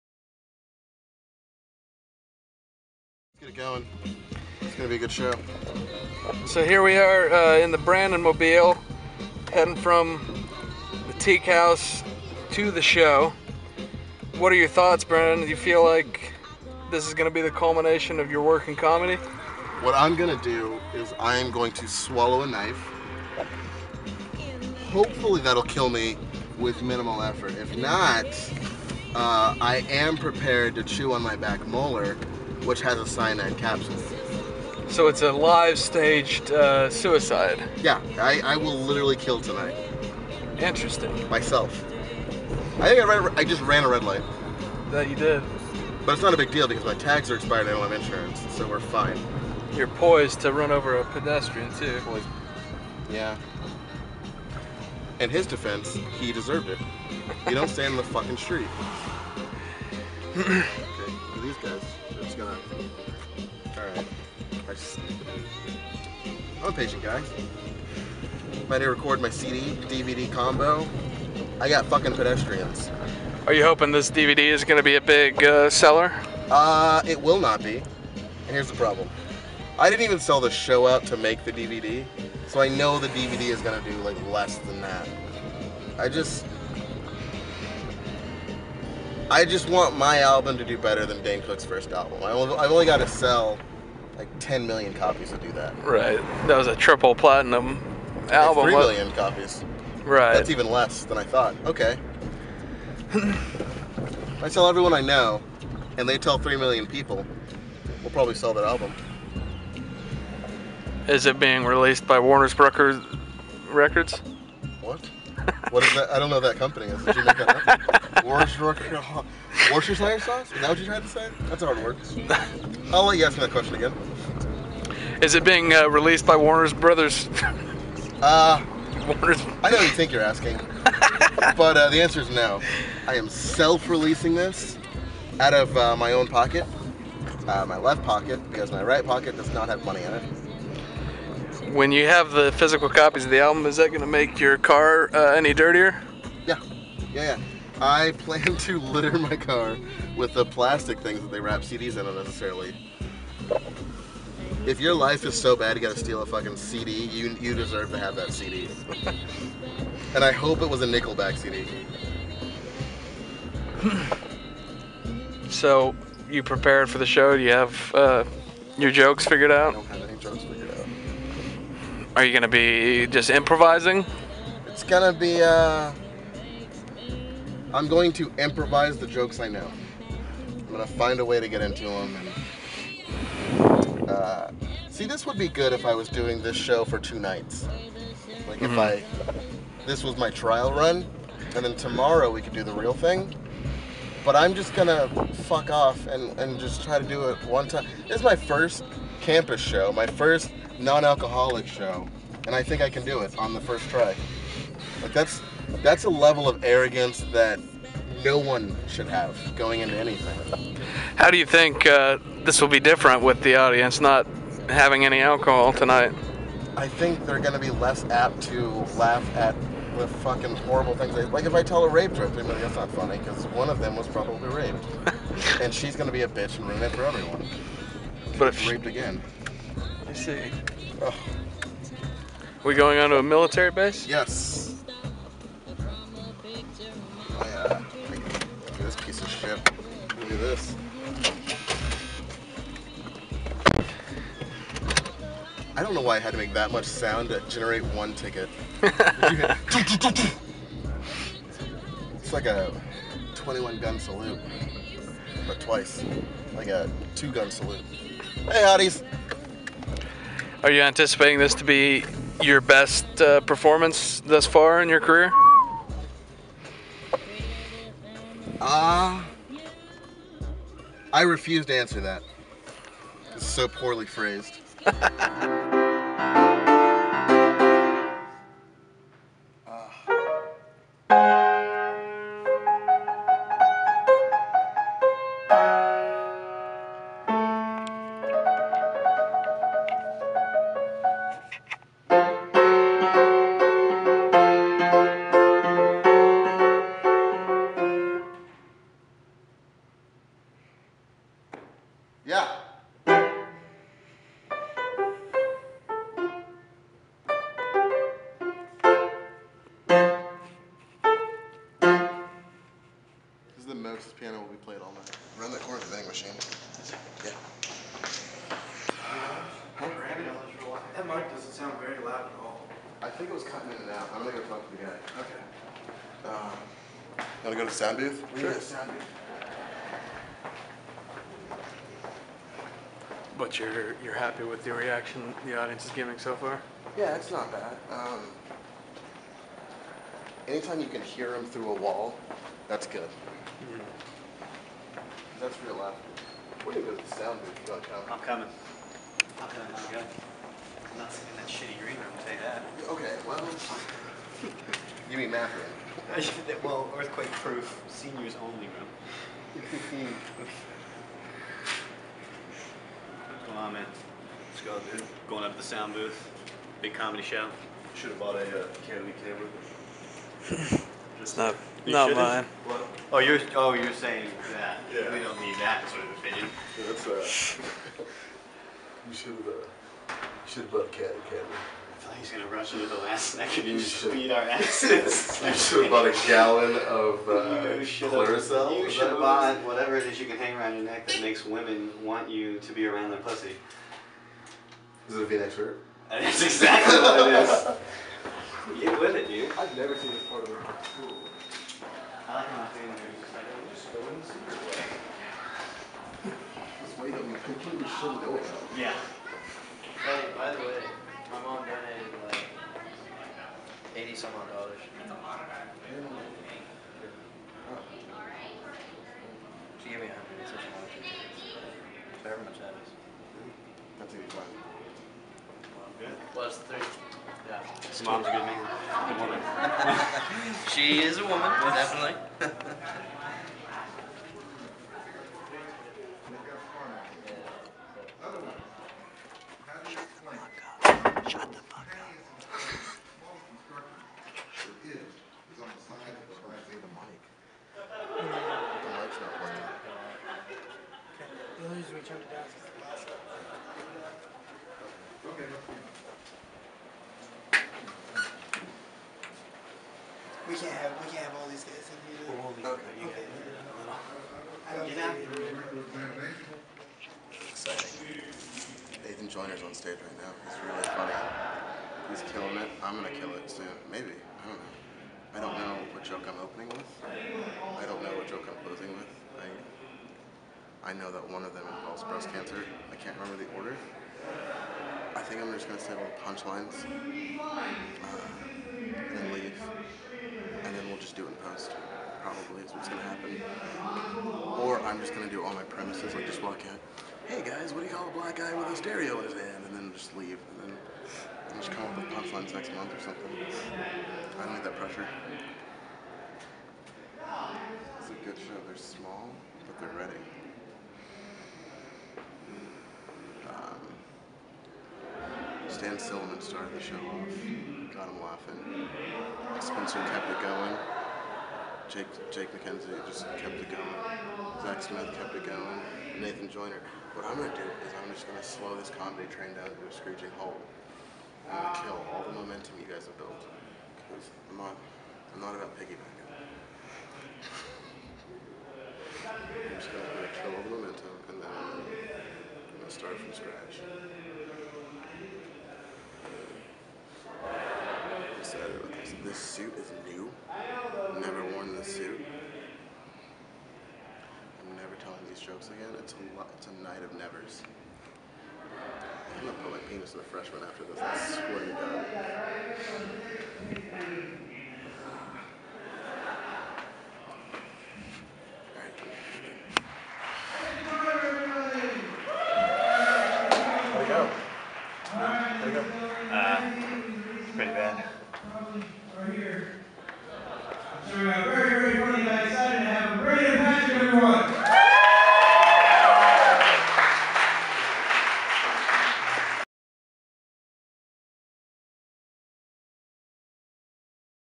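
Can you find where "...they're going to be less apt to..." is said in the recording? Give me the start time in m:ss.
3:37.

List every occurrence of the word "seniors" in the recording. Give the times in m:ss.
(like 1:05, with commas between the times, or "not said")
5:57.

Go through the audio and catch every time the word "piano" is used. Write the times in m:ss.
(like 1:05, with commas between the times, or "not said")
5:14.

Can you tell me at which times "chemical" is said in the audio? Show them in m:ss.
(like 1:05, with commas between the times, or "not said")
not said.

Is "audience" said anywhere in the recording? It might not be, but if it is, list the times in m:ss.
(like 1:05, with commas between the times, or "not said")
3:33, 5:35.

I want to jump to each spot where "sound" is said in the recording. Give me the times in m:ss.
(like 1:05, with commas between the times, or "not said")
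4:06, 5:21, 5:27, 5:47, 6:05.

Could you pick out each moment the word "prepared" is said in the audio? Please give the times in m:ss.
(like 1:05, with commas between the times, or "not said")
0:30, 2:46.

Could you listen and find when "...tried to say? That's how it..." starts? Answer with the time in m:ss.
2:00.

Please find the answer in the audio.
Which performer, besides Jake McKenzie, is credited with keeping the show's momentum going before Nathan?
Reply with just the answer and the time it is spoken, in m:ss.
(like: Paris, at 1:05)
Zach Smith, at 8:44.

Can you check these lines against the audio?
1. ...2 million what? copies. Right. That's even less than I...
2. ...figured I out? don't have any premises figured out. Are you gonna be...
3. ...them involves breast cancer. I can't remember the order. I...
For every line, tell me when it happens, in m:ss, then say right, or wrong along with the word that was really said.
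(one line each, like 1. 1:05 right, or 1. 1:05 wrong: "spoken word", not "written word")
1. 1:38 wrong: "3", not "2"
2. 2:49 wrong: "jokes", not "premises"
3. 8:01 right.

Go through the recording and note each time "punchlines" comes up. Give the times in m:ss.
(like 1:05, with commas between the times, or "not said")
8:06, 8:22.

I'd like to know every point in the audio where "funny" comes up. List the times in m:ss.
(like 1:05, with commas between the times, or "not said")
3:42, 7:50, 9:42.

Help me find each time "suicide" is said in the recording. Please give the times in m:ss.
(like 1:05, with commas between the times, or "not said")
0:36.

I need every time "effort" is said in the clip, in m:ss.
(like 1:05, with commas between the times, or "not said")
0:27.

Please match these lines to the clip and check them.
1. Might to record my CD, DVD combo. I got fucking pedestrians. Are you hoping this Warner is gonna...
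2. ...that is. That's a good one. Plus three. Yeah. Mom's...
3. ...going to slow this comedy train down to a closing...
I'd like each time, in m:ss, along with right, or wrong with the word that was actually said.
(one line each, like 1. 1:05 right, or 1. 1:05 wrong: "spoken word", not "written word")
1. 1:08 wrong: "DVD", not "Warner"
2. 7:02 right
3. 8:48 wrong: "screeching", not "closing".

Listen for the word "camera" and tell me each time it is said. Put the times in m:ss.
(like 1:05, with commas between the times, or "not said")
6:09, 6:21.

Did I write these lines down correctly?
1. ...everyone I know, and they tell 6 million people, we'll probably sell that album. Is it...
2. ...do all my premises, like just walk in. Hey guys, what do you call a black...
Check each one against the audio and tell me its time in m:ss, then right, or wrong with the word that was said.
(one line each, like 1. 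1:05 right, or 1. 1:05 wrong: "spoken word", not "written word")
1. 1:44 wrong: "3", not "6"
2. 8:15 right.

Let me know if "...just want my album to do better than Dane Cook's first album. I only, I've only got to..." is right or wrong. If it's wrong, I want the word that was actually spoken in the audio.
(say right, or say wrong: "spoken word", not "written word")
right.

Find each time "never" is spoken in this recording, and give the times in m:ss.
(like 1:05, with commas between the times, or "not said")
6:39, 9:17.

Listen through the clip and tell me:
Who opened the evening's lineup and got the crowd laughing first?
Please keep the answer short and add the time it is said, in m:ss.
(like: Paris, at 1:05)
Stan Silliman, at 8:35.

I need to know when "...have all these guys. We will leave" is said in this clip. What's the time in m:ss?
7:41.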